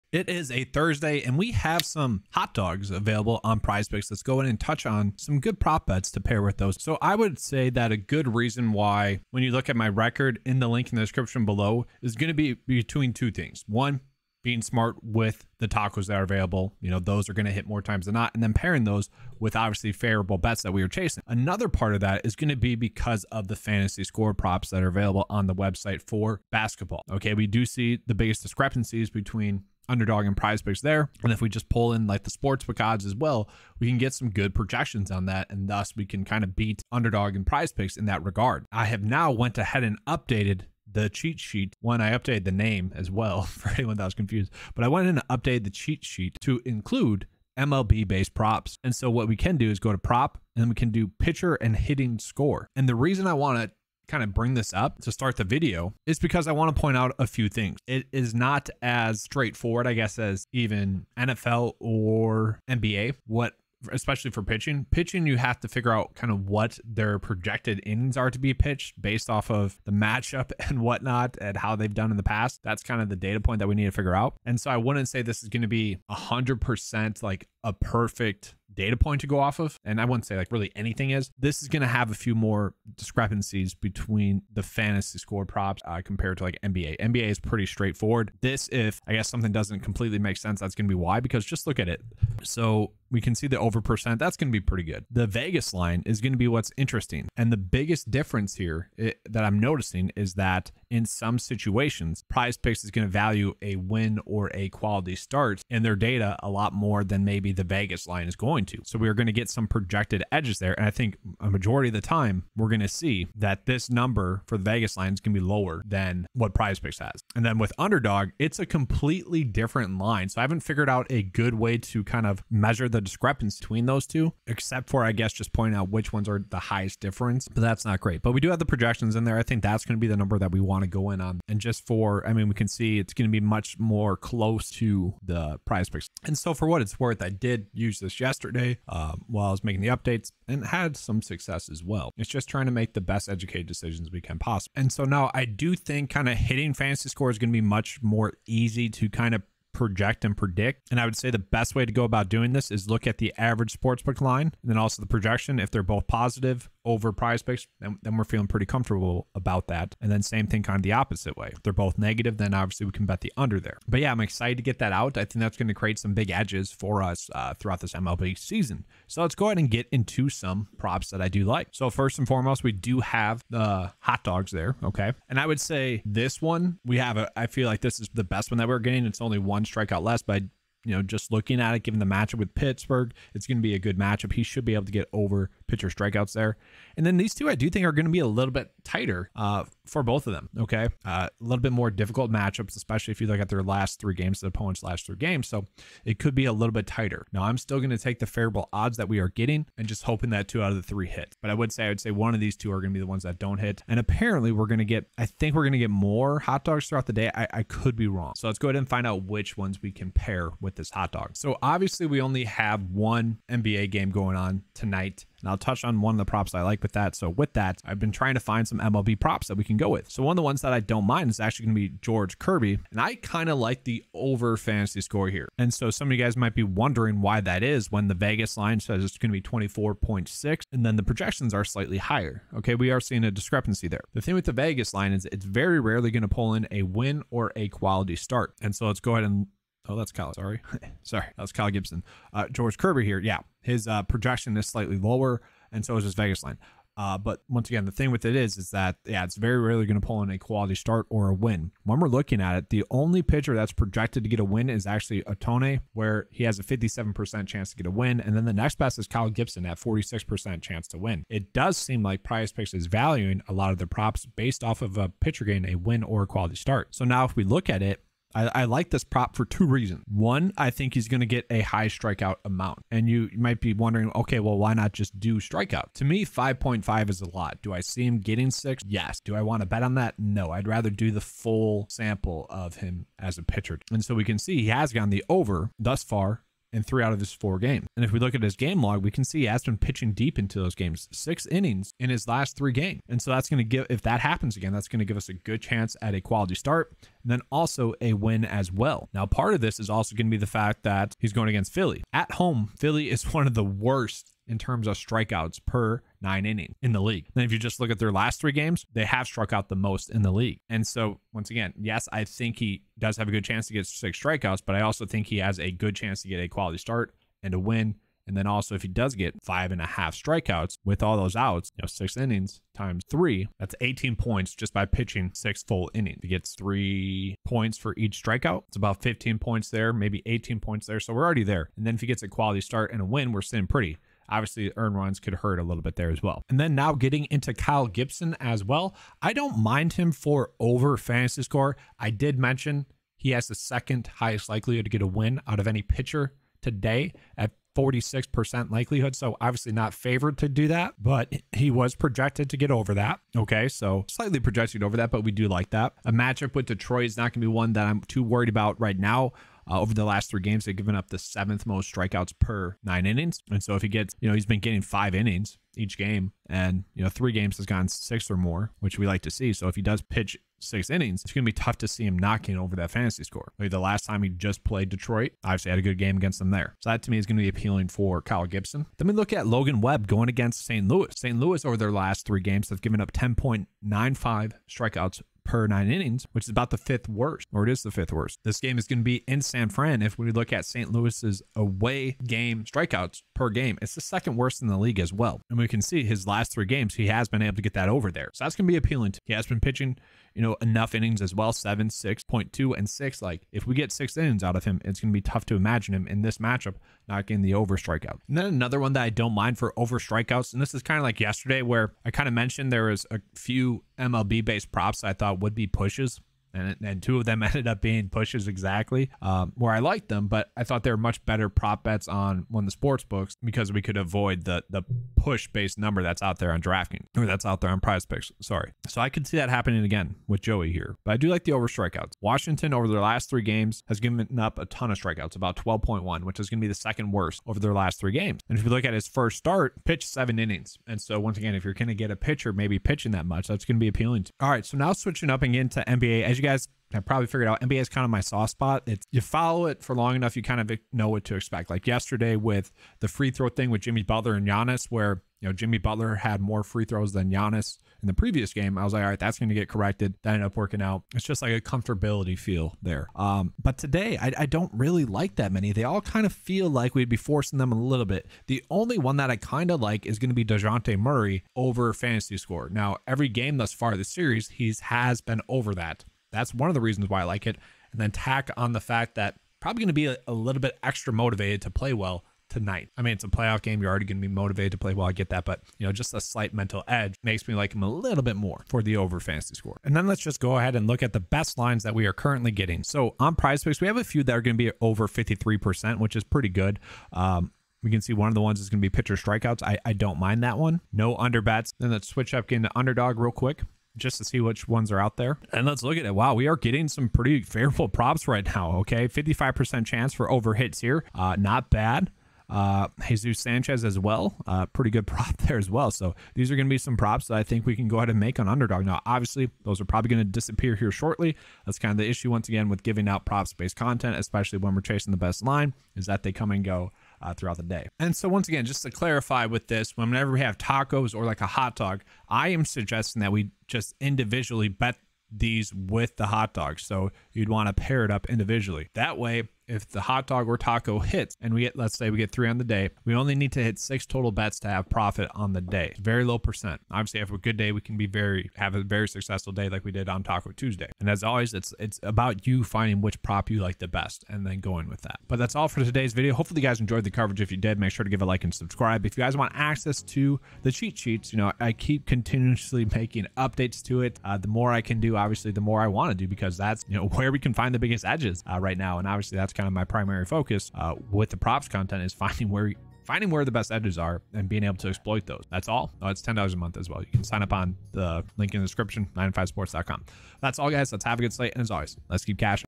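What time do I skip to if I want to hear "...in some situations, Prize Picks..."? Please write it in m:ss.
1:40.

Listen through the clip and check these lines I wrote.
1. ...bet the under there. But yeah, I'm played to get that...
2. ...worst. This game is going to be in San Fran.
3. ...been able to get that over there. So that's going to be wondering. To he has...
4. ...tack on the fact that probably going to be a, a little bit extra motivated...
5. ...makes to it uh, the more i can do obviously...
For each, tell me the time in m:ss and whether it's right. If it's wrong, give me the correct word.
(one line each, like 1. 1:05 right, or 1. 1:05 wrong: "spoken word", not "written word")
1. 2:43 wrong: "excited", not "played"
2. 6:28 right
3. 6:37 wrong: "appealing", not "wondering"
4. 7:58 right
5. 9:23 wrong: "updates", not "makes".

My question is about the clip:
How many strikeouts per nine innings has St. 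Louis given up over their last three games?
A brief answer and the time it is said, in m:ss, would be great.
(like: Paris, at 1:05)
10.95, at 6:23.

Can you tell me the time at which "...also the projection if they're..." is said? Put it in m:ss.
2:34.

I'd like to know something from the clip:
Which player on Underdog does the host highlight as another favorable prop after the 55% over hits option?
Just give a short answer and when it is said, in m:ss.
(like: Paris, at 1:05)
Jesus Sanchez, at 8:33.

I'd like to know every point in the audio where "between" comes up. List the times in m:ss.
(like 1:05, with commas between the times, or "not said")
0:12, 0:29, 1:23, 2:03.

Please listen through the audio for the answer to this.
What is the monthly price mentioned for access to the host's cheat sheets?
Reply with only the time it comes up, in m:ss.
9:36.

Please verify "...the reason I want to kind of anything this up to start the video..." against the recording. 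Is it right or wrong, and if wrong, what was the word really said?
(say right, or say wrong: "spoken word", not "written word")
wrong: "bring", not "anything".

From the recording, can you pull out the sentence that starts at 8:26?
Wow, we are getting some pretty favorable props right now.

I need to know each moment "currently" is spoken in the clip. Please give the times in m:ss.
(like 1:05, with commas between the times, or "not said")
8:12.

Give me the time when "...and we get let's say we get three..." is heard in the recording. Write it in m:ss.
9:01.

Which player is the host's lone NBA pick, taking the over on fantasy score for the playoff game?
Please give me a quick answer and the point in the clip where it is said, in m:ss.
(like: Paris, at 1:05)
Dejounte Murray, at 7:50.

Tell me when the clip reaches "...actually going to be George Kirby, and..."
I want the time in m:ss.
3:41.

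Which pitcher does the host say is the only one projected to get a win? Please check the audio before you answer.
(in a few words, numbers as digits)
Ohtani.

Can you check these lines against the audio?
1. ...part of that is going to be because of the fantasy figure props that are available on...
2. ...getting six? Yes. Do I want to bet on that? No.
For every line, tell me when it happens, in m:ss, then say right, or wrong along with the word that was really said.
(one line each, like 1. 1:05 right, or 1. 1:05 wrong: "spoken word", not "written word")
1. 0:21 wrong: "score", not "figure"
2. 4:38 right.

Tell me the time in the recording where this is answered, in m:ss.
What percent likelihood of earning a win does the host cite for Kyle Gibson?
4:19.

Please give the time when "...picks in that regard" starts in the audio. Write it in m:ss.
0:37.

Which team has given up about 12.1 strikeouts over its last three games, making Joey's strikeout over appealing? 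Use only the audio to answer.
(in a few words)
Washington.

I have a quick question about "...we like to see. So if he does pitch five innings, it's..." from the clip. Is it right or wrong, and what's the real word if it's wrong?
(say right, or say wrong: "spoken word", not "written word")
wrong: "six", not "five".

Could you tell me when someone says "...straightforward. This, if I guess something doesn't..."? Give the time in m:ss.
1:27.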